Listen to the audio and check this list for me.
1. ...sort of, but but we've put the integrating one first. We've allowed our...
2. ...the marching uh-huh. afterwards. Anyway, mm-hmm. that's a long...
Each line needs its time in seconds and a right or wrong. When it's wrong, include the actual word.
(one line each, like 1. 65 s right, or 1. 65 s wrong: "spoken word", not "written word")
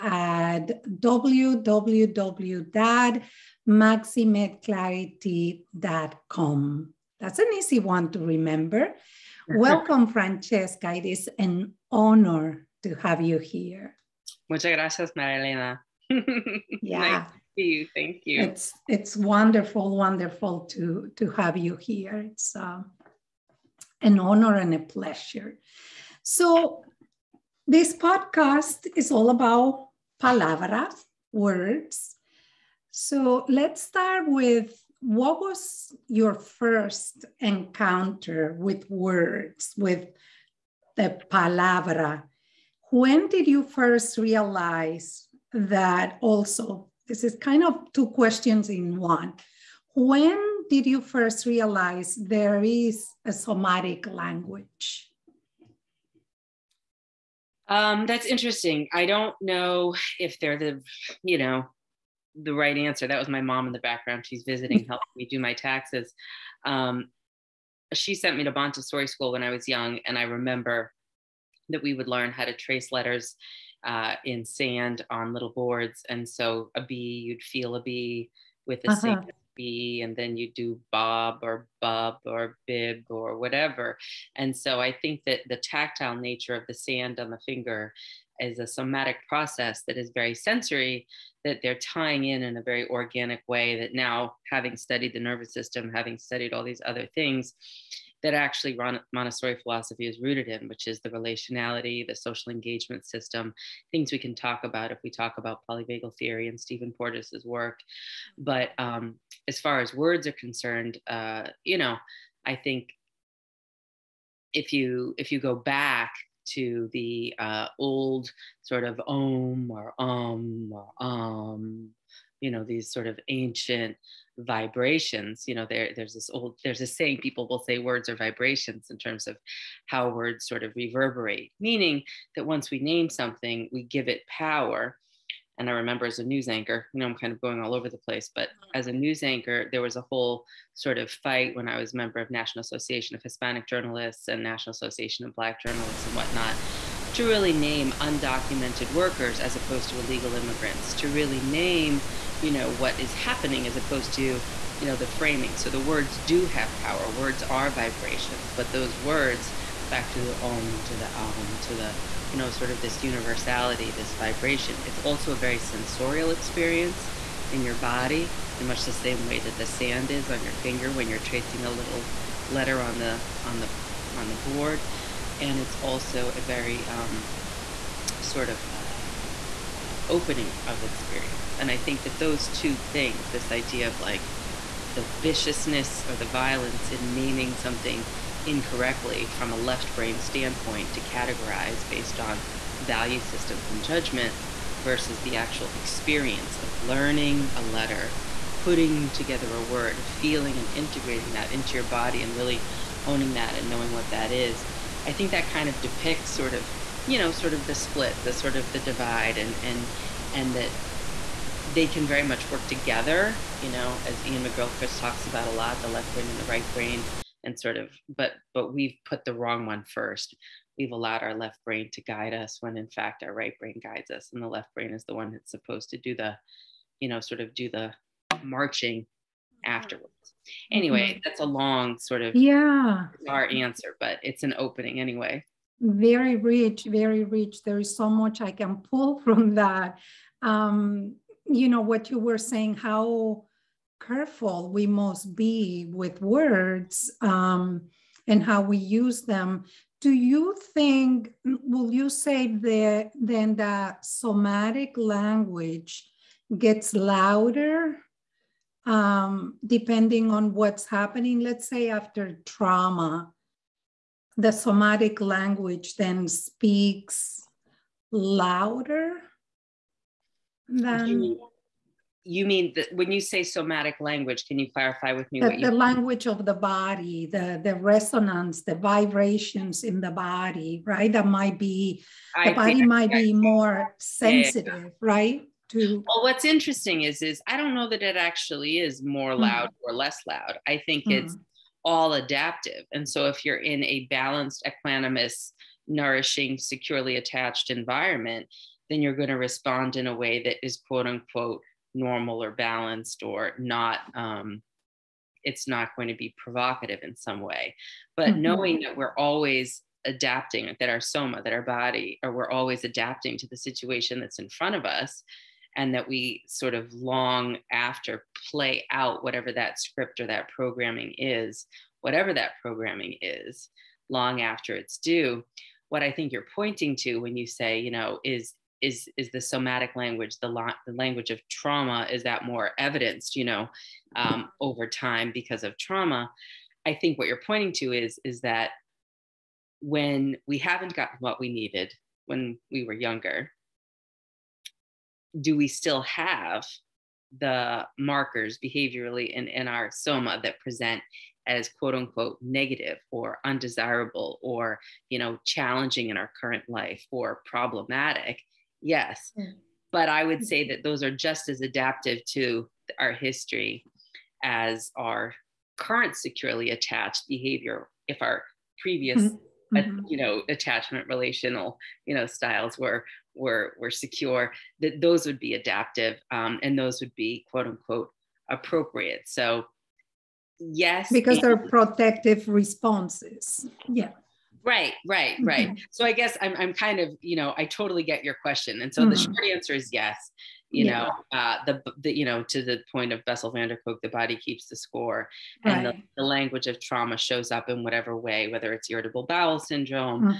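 1. 217 s wrong: "wrong", not "integrating"
2. 227 s right.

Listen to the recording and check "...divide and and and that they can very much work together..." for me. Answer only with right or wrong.
right.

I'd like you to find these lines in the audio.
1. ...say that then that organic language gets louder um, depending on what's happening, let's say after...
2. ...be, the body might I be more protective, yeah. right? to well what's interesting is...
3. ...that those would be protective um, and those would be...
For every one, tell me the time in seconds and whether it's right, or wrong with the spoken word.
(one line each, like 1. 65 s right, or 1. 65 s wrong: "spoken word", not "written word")
1. 252 s wrong: "somatic", not "organic"
2. 281 s wrong: "sensitive", not "protective"
3. 374 s wrong: "adaptive", not "protective".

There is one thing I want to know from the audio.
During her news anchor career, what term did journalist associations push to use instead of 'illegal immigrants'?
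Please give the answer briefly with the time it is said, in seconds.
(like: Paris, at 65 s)
undocumented workers, at 147 s.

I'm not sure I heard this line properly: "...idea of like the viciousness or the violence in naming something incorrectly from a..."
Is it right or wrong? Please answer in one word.
right.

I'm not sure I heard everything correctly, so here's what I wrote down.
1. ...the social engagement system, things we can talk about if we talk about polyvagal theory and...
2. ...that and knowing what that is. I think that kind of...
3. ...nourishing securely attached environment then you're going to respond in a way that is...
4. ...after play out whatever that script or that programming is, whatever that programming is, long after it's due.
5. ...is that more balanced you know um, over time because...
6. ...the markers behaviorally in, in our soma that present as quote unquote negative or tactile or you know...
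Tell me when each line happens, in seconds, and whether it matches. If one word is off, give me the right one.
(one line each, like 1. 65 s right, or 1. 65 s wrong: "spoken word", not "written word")
1. 102 s right
2. 203 s right
3. 295 s right
4. 317 s right
5. 332 s wrong: "evidenced", not "balanced"
6. 347 s wrong: "undesirable", not "tactile".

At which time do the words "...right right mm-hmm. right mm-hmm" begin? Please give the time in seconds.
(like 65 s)
384 s.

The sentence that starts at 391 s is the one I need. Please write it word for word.
know uh, the, the you know to the point of bessel van der kolk the body keeps the score right.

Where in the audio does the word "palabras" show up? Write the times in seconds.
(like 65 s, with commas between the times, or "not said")
30 s, 41 s.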